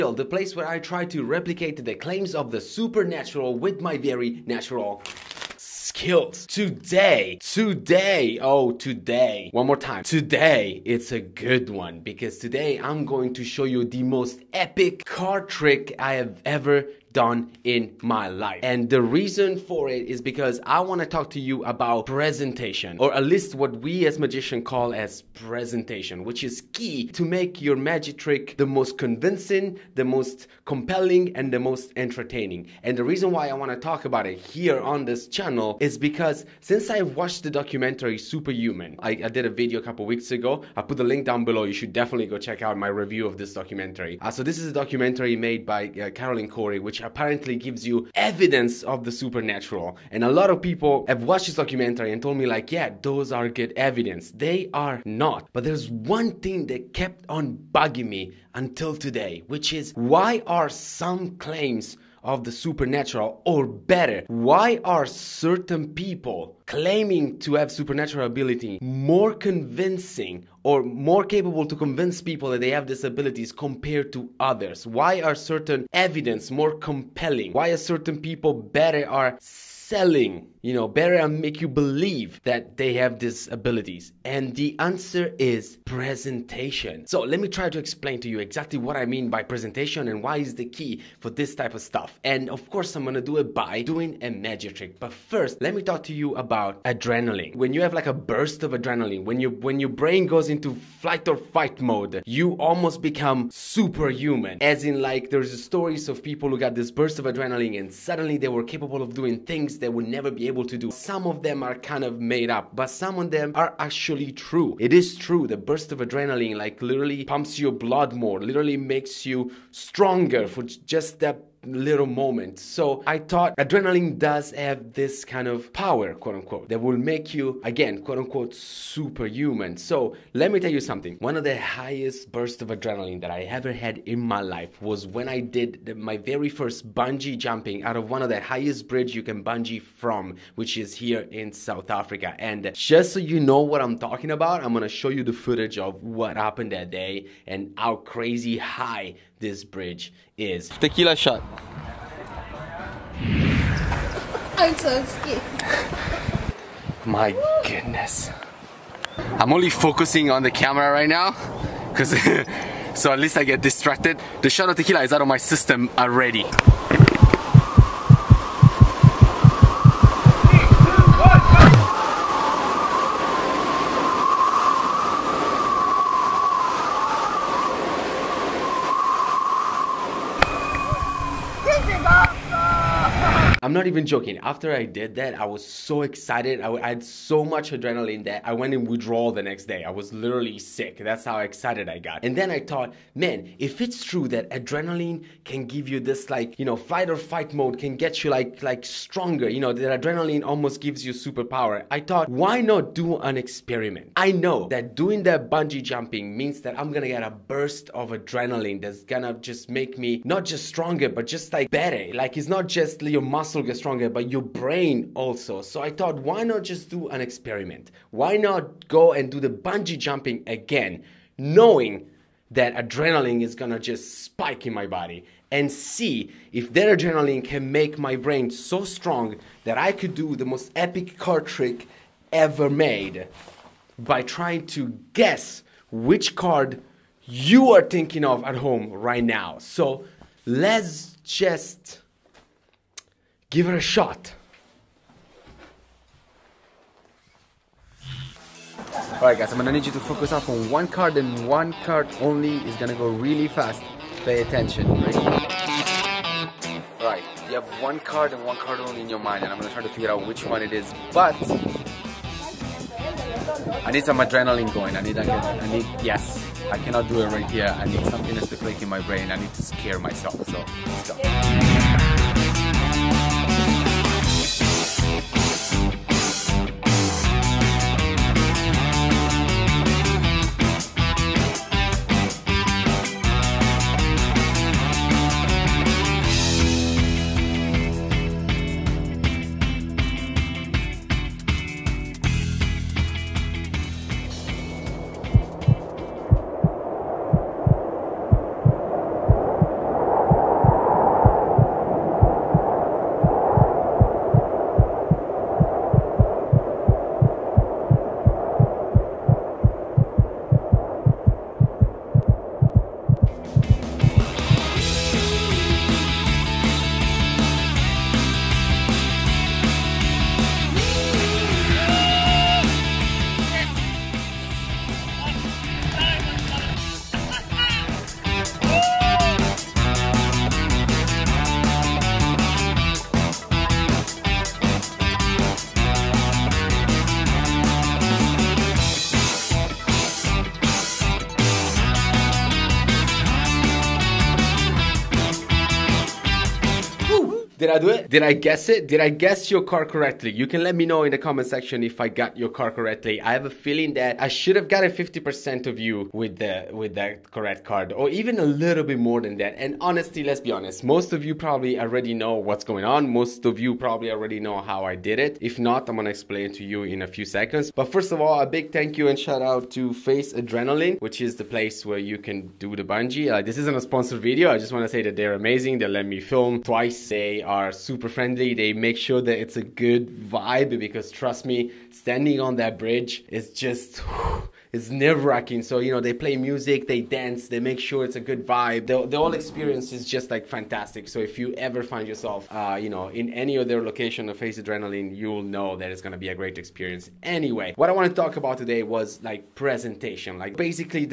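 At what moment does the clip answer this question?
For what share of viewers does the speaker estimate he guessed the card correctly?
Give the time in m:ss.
5:54.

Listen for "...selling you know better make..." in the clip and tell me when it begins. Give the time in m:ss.
1:19.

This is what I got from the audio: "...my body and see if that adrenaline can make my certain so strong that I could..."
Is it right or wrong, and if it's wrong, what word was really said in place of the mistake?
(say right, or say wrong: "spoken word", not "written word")
wrong: "brain", not "certain".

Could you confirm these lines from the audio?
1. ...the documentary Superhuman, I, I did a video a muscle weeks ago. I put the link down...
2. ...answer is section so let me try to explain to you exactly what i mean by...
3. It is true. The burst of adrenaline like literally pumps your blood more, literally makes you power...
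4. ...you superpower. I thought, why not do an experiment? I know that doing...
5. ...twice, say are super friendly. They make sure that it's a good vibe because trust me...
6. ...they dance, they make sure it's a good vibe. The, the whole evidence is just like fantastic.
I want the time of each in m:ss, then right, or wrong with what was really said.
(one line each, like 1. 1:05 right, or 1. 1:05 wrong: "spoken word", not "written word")
1. 0:37 wrong: "couple", not "muscle"
2. 1:24 wrong: "presentation", not "section"
3. 1:54 wrong: "stronger", not "power"
4. 3:21 right
5. 6:16 right
6. 6:26 wrong: "experience", not "evidence".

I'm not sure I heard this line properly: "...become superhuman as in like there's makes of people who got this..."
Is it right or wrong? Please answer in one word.
wrong.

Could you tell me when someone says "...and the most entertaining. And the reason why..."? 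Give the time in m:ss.
0:31.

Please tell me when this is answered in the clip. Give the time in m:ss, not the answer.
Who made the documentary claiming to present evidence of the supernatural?
0:46.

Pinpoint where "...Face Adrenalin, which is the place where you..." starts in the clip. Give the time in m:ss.
6:09.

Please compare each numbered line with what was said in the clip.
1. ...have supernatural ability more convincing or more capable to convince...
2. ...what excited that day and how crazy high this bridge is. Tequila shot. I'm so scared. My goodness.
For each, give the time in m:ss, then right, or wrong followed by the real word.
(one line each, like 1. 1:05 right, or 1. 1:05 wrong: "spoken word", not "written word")
1. 1:07 right
2. 2:26 wrong: "happened", not "excited".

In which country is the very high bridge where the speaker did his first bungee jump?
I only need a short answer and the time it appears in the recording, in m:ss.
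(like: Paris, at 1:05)
South Africa, at 2:21.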